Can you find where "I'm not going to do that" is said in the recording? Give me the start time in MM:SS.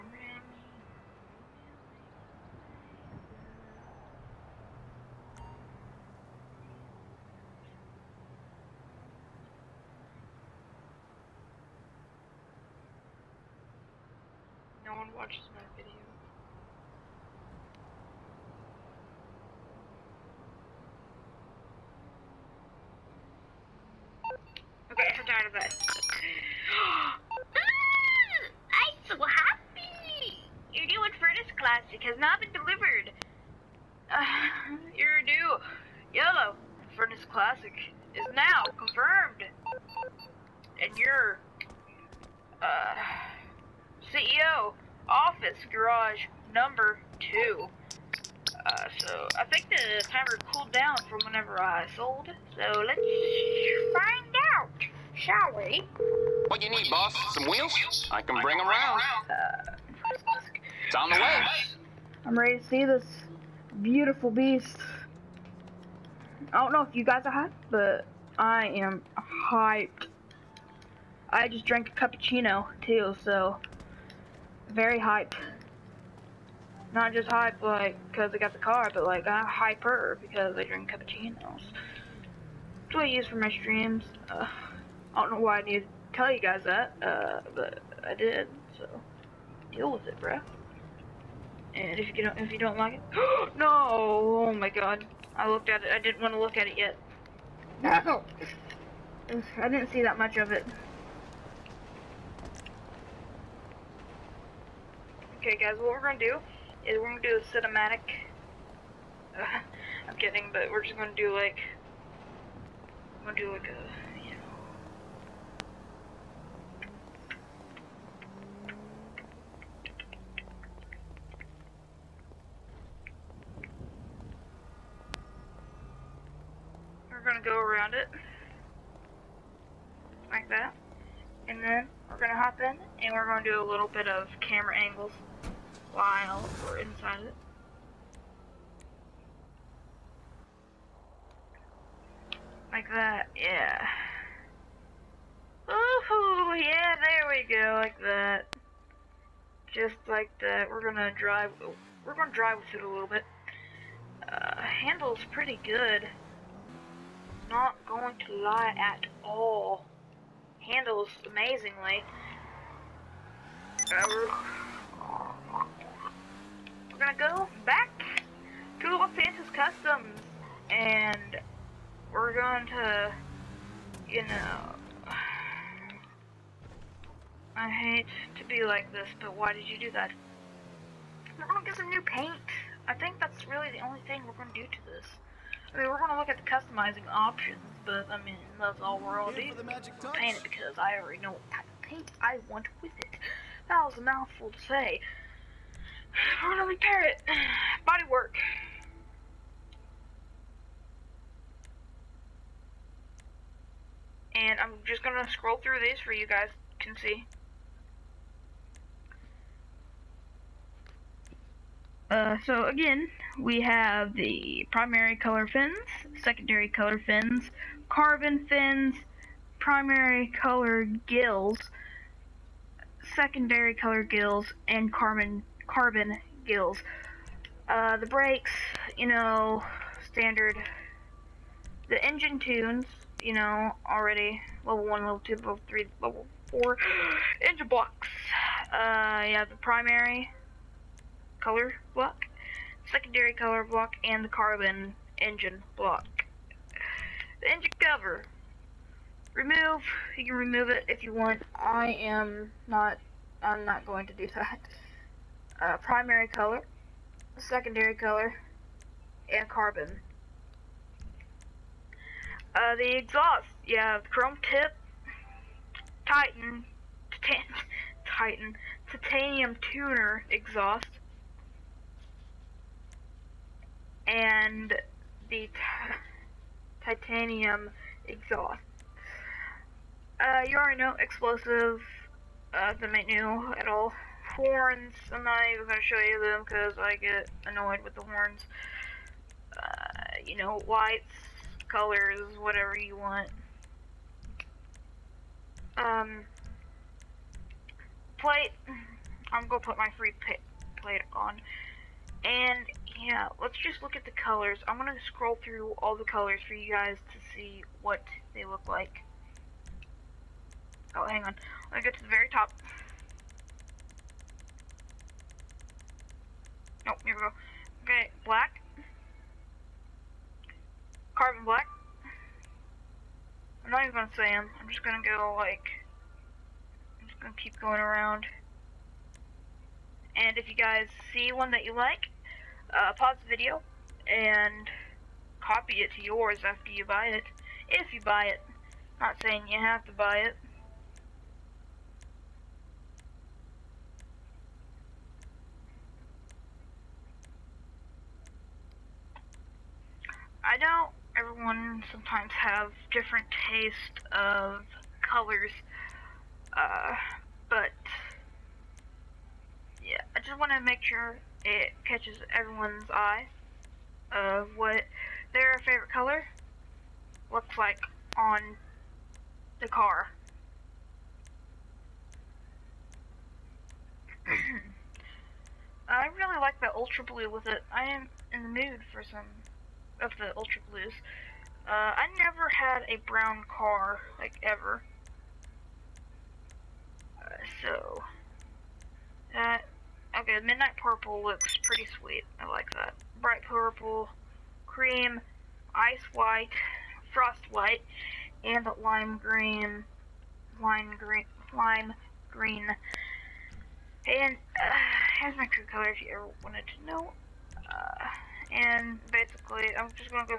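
04:13.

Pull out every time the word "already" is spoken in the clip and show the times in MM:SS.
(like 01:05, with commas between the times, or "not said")
03:11, 03:53, 04:40.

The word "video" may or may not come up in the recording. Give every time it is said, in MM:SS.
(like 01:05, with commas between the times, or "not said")
00:15, 05:33.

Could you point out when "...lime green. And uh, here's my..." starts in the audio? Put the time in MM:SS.
06:41.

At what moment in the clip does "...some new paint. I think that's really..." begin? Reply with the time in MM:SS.
03:01.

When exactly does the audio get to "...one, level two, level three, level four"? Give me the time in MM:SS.
03:54.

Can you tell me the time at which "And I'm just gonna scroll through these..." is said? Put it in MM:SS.
03:24.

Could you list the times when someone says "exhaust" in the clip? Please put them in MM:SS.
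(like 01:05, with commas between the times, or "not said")
04:22, 04:30, 04:38.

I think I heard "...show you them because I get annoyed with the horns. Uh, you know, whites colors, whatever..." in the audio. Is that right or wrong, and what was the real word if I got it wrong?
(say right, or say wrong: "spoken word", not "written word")
right.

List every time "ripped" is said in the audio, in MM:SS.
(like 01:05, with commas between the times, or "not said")
not said.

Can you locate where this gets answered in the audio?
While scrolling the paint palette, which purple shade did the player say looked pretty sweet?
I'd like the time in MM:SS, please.
06:30.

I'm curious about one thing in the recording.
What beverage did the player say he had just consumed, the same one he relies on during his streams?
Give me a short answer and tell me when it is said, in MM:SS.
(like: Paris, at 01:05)
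Cappuccino, at 01:11.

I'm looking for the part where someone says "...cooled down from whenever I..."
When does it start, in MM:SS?
00:50.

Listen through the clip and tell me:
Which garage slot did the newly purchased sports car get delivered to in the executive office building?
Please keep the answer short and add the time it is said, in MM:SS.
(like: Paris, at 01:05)
Garage number 2, at 00:45.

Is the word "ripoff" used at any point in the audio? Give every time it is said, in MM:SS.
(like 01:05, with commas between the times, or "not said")
not said.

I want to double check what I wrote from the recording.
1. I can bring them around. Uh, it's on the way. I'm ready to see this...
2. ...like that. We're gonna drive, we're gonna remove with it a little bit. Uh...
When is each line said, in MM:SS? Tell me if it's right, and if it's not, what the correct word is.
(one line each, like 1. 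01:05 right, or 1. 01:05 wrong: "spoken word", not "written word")
1. 00:58 right
2. 02:30 wrong: "drive", not "remove".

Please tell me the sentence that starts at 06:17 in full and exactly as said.
I am in the mood for some of the ultra blues.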